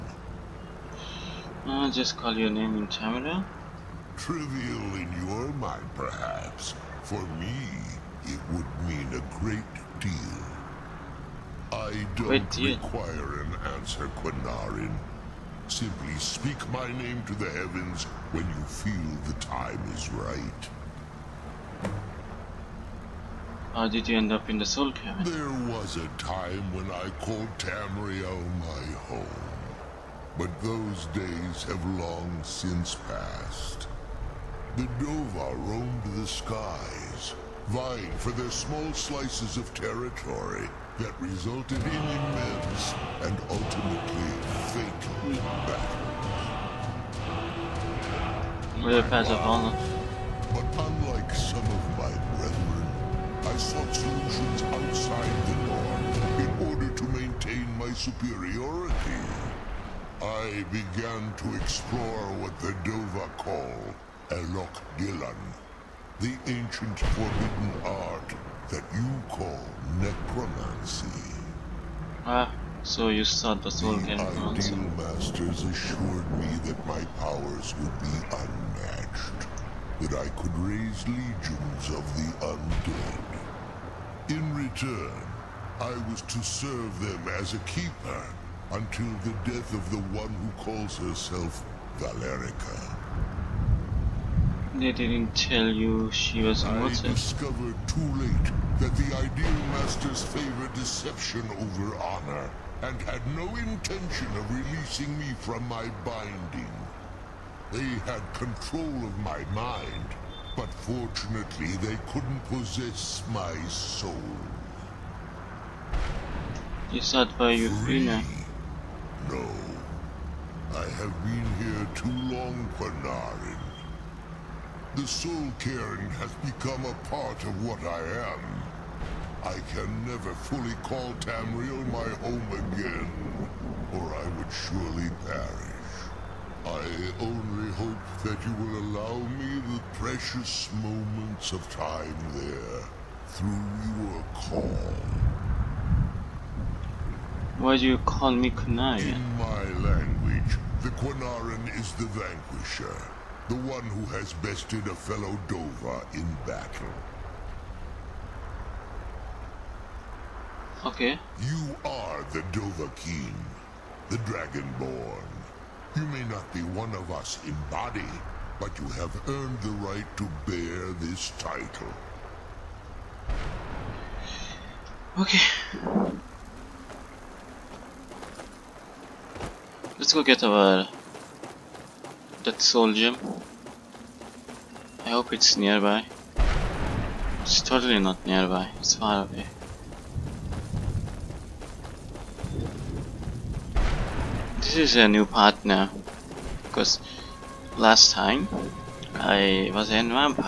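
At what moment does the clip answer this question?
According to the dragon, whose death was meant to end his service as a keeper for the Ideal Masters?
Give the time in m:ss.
1:31.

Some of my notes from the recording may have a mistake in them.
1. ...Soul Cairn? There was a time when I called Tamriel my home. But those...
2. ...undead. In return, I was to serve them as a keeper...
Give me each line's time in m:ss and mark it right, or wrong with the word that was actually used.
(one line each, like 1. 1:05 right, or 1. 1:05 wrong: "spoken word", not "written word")
1. 0:24 right
2. 1:22 right.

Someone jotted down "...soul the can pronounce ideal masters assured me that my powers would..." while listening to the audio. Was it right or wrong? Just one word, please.
right.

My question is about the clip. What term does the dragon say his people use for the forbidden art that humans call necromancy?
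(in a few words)
Elok Dylan.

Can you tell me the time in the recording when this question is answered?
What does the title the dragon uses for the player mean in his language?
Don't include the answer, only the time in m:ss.
2:31.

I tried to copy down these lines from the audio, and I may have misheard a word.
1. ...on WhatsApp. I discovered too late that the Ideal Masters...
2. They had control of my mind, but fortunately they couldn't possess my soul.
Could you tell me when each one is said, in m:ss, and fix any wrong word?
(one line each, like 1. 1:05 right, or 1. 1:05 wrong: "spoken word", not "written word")
1. 1:36 right
2. 1:47 right.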